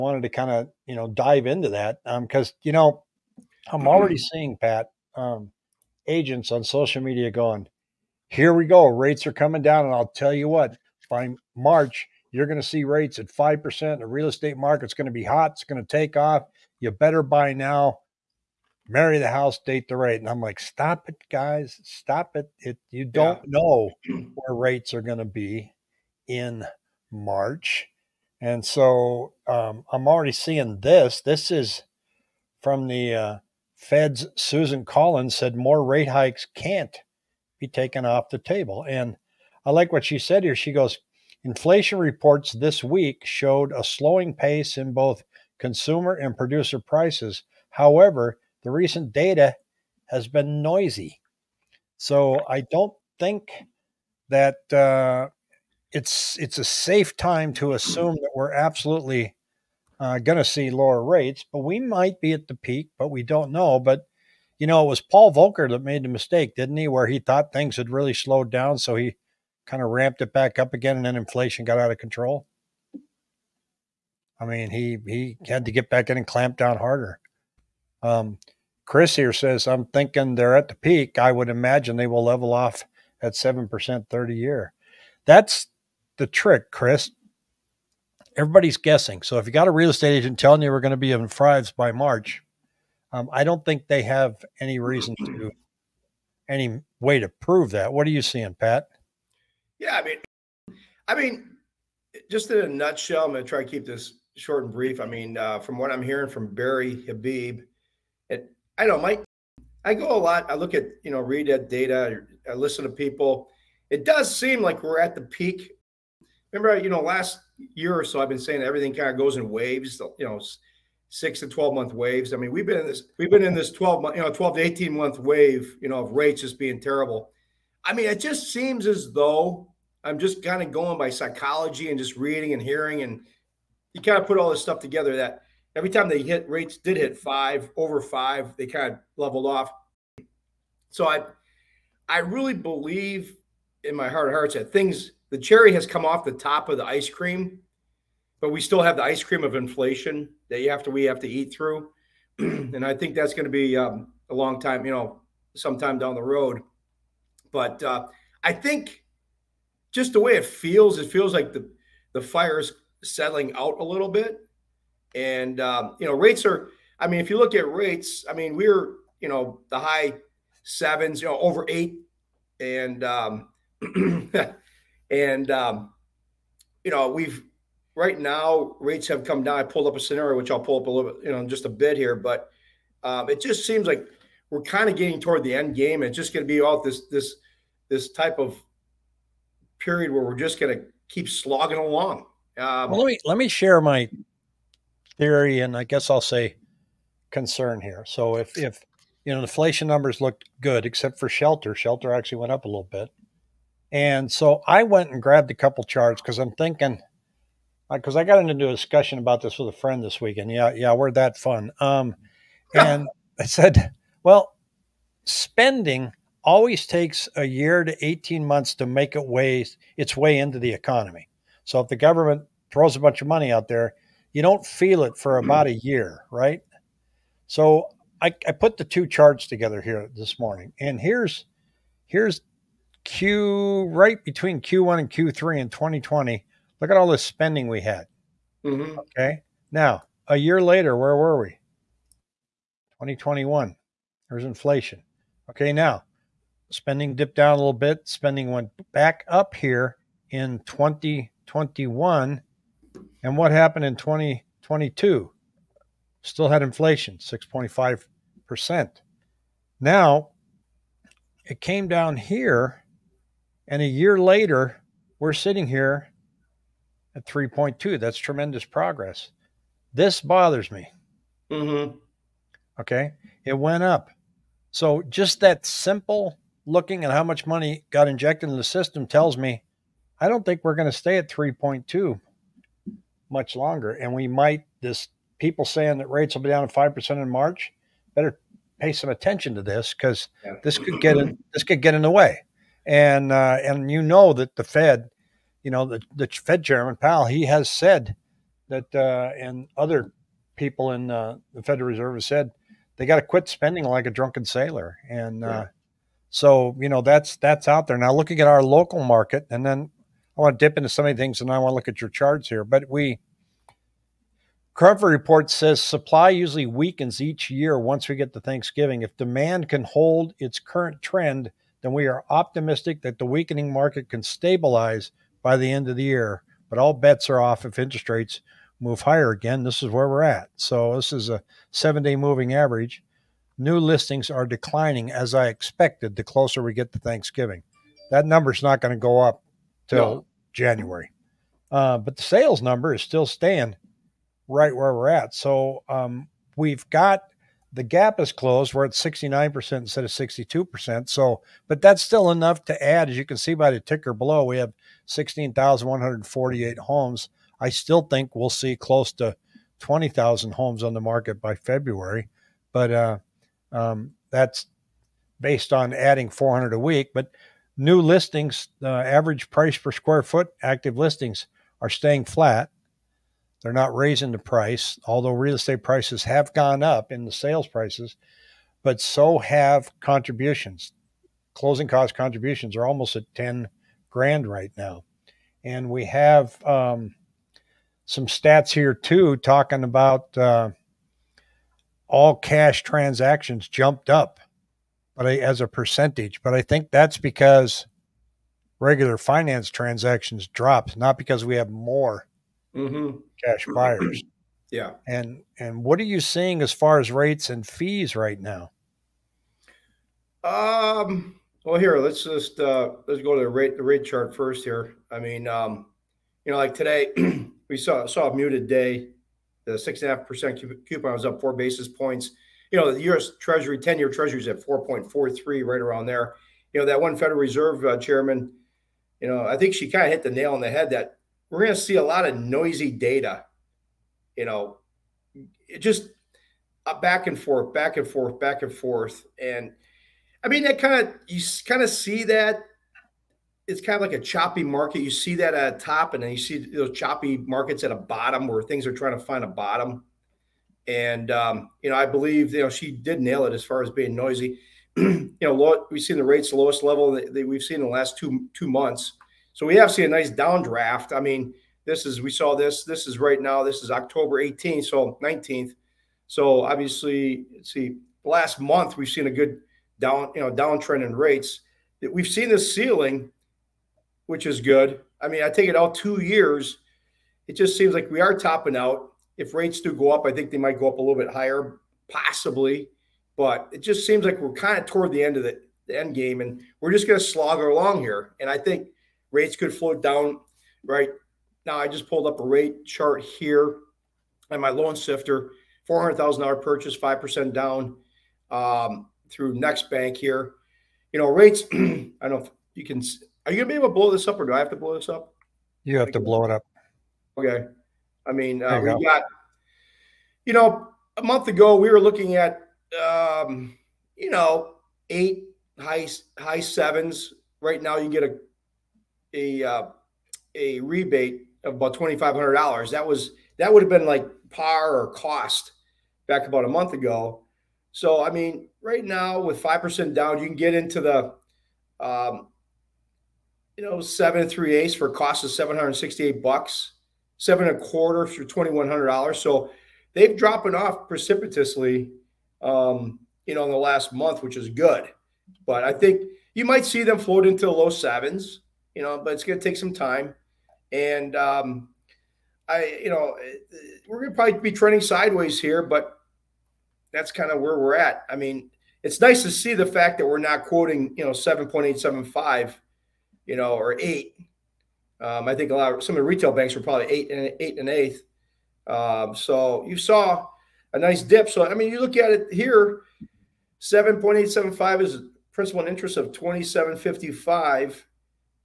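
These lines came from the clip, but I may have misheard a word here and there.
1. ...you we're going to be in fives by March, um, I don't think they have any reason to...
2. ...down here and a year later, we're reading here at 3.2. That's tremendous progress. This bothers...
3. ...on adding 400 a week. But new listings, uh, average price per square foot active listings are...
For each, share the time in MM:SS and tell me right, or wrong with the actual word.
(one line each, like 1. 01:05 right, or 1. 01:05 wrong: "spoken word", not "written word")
1. 01:30 right
2. 04:21 wrong: "sitting", not "reading"
3. 06:05 right.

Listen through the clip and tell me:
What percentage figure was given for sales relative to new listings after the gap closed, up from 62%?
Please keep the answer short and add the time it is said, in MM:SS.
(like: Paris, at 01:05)
69%, at 05:48.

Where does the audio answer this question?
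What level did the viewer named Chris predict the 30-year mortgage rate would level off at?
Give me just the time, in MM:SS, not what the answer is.
01:23.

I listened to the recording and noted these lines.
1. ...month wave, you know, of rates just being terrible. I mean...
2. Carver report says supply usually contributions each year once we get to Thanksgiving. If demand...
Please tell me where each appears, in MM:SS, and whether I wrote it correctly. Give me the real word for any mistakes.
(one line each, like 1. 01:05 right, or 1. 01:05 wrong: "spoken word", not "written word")
1. 02:04 right
2. 05:14 wrong: "weakens", not "contributions".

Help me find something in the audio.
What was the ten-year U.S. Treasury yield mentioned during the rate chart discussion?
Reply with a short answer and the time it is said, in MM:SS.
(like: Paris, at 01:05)
4.43, at 07:04.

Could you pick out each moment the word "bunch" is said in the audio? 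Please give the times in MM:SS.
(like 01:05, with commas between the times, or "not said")
03:43.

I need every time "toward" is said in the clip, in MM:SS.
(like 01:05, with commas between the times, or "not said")
03:05, 08:04.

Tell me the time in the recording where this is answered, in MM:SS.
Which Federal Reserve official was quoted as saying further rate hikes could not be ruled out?
00:34.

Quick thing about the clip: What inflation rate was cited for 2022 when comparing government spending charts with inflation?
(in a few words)
6.5%.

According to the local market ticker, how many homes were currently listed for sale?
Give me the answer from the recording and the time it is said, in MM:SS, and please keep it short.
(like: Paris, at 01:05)
16,148, at 05:55.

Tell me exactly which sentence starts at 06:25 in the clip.
And we have um, some stats here too talking about uh, all cash transactions jumped up but I, as a percentage.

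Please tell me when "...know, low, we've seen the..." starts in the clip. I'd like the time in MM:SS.
07:35.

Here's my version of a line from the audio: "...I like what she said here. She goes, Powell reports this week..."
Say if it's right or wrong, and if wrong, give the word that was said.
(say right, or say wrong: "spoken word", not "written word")
wrong: "Inflation", not "Powell".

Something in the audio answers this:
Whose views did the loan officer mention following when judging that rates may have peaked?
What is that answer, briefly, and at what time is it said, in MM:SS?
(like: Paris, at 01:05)
Barry Habib, at 01:46.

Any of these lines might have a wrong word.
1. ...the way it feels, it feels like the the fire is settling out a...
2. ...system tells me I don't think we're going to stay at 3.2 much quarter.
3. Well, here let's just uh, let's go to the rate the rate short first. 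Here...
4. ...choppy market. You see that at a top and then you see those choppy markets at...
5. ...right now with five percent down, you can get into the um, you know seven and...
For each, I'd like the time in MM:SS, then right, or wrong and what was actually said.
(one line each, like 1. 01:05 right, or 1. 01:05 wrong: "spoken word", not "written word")
1. 02:40 right
2. 04:38 wrong: "longer", not "quarter"
3. 06:51 wrong: "chart", not "short"
4. 07:24 right
5. 08:48 right.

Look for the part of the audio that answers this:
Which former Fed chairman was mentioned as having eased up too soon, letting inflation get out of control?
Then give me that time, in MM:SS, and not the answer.
01:05.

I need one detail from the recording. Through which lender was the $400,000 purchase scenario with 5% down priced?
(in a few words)
Next Bank.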